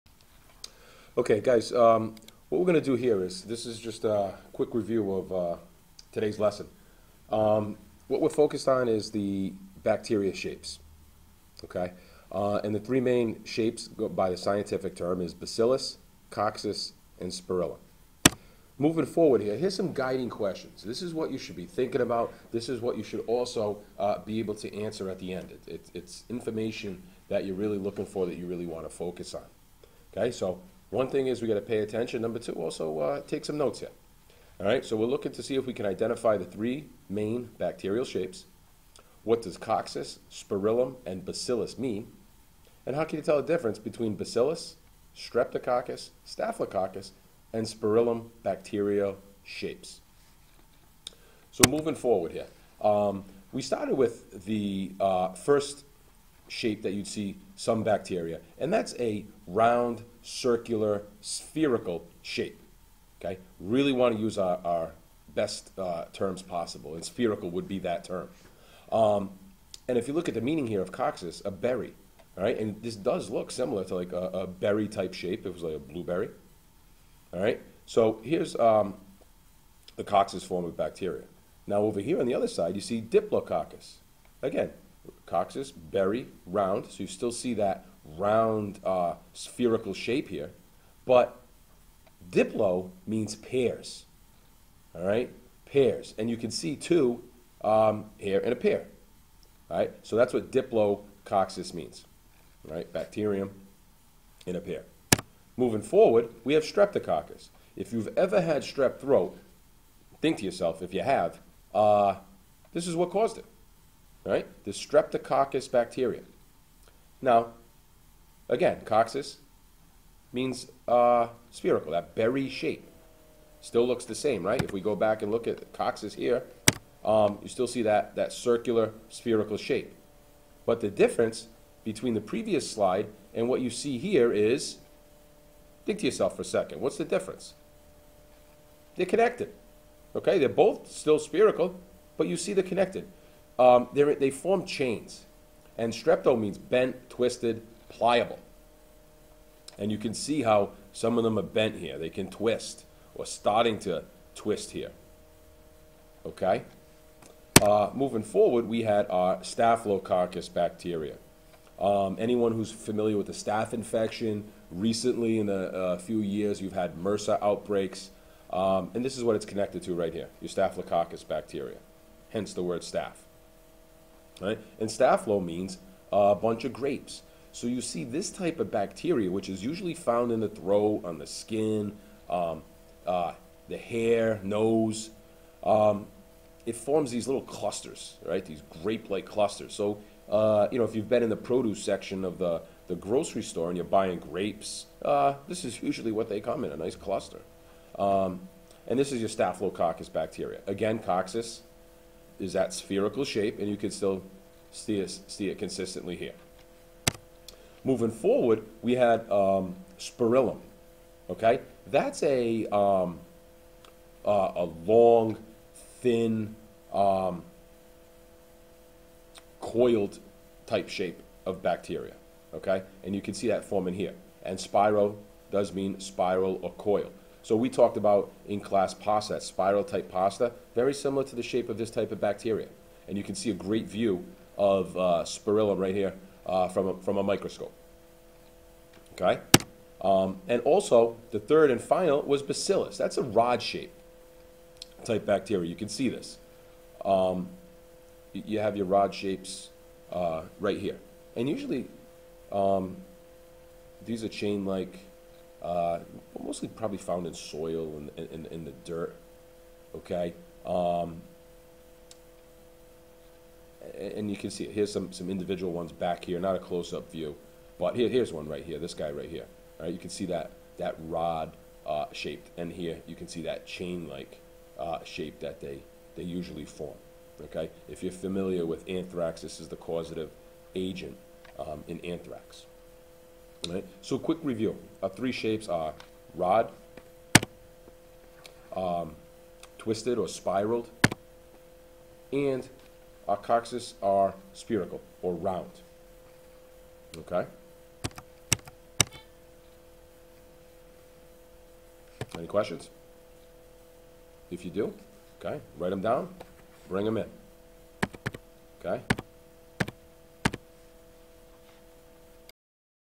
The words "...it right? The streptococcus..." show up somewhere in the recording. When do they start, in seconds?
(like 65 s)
113 s.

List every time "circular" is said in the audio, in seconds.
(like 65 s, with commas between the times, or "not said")
60 s, 128 s.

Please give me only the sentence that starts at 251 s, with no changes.
And usually, um, these are chain-like uh, mostly probably found in soil and in, in, the dirt.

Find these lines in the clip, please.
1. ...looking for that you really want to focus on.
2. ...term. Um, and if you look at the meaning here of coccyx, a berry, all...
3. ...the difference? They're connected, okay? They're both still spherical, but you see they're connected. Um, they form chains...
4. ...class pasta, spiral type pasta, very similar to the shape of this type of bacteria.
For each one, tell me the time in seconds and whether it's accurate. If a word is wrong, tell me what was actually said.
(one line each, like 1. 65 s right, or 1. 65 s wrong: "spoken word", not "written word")
1. 27 s right
2. 68 s right
3. 136 s right
4. 228 s right.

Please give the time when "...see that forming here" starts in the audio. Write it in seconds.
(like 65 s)
223 s.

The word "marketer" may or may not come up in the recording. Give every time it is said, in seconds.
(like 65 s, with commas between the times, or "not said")
not said.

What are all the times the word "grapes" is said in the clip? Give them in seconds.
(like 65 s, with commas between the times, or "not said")
176 s, 188 s, 194 s.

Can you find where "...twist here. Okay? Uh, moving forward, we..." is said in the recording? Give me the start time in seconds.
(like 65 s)
154 s.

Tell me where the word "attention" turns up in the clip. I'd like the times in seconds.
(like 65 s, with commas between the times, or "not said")
31 s.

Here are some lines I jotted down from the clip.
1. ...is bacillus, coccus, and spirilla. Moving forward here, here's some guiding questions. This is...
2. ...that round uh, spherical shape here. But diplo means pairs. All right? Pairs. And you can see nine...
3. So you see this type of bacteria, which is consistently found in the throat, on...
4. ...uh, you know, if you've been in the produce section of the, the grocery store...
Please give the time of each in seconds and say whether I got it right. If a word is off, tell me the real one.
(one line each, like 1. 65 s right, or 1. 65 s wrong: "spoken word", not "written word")
1. 15 s right
2. 87 s wrong: "two", not "nine"
3. 177 s wrong: "usually", not "consistently"
4. 190 s right.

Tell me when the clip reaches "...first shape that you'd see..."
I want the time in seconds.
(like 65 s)
55 s.